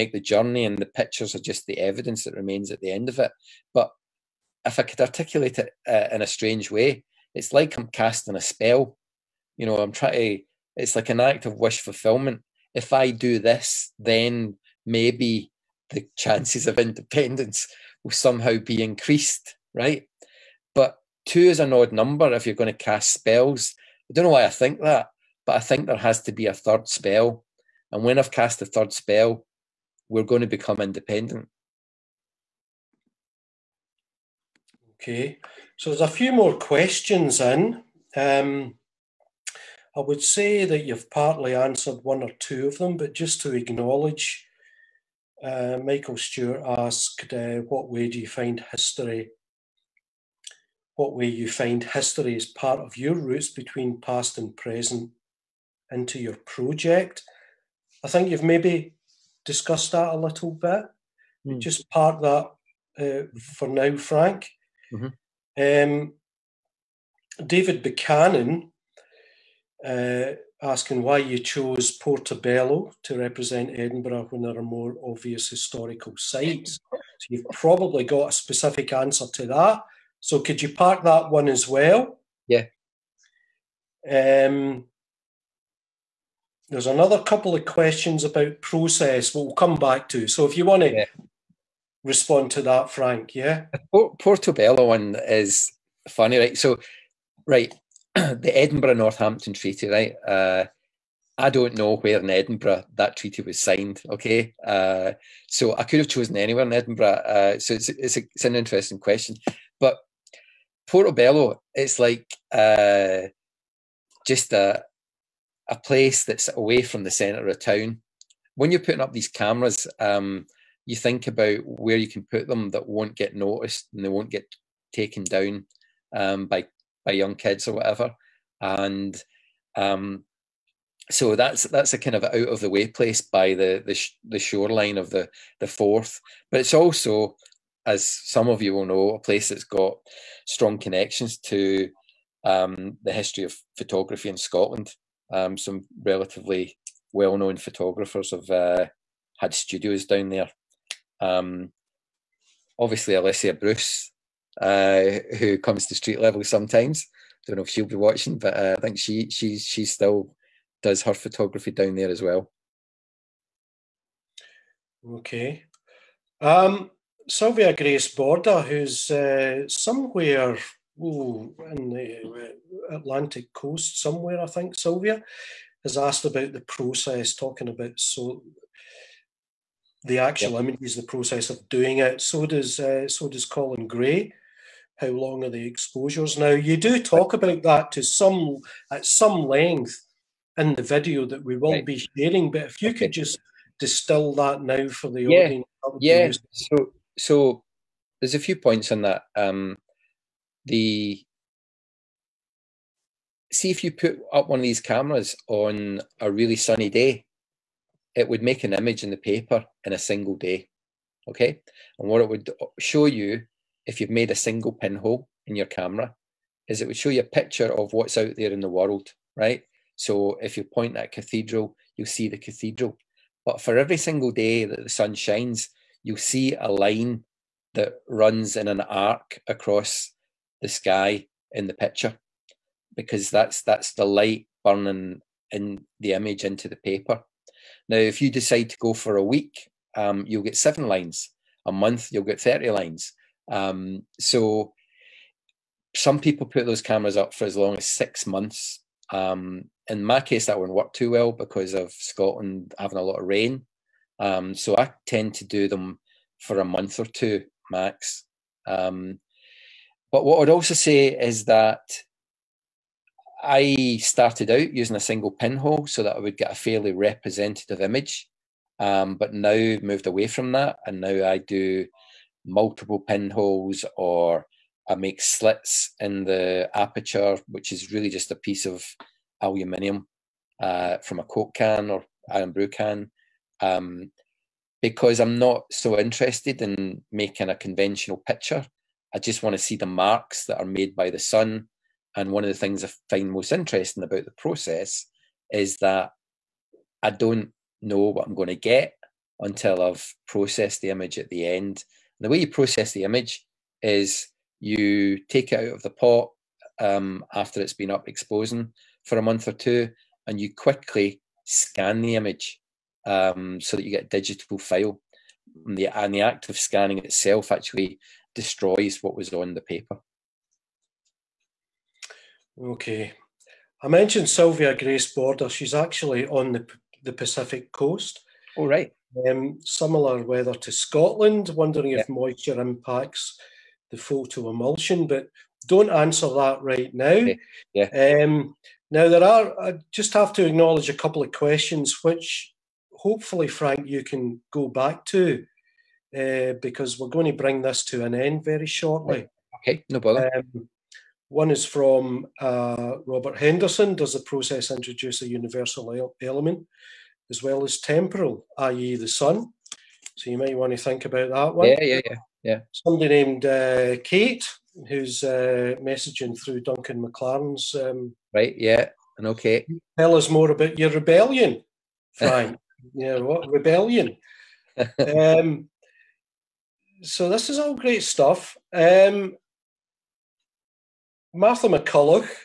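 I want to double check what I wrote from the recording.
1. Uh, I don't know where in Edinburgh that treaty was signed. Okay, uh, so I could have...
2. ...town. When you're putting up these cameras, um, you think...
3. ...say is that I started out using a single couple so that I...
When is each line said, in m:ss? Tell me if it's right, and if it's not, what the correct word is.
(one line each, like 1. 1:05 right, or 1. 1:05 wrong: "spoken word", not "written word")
1. 1:40 right
2. 1:57 right
3. 4:20 wrong: "pinhole", not "couple".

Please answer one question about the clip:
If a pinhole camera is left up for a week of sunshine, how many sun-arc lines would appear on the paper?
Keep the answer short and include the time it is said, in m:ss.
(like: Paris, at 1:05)
7, at 4:00.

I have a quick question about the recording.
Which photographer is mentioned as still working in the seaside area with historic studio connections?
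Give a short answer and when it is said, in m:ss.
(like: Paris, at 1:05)
Alicia Bruce, at 2:33.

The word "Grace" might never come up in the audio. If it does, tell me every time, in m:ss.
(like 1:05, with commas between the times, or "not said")
2:47, 5:24.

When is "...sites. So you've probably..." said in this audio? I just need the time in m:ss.
1:16.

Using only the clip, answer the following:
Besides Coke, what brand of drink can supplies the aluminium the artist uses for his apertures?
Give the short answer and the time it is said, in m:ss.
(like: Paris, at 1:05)
Irn-Bru, at 4:42.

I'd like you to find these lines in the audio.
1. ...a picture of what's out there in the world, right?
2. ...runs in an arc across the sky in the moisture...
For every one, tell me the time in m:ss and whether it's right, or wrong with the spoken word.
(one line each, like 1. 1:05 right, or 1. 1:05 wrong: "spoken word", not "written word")
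1. 3:37 right
2. 3:48 wrong: "picture", not "moisture".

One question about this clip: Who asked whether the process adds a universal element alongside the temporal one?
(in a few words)
Robert Henderson.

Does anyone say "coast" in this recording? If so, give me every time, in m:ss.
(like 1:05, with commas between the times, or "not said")
2:53, 5:27.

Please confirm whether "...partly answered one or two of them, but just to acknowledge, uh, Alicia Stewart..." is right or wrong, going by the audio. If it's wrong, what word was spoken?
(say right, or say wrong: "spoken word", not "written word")
wrong: "Michael", not "Alicia".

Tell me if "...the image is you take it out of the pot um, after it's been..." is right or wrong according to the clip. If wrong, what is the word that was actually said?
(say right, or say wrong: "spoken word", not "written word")
right.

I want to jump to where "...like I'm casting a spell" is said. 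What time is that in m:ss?
0:07.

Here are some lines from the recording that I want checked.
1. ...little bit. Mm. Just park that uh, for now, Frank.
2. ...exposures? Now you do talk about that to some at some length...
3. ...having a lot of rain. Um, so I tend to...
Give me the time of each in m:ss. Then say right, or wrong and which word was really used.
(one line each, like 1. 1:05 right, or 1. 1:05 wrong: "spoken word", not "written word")
1. 1:00 right
2. 3:05 right
3. 4:12 right.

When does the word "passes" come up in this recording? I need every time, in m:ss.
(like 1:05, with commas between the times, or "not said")
not said.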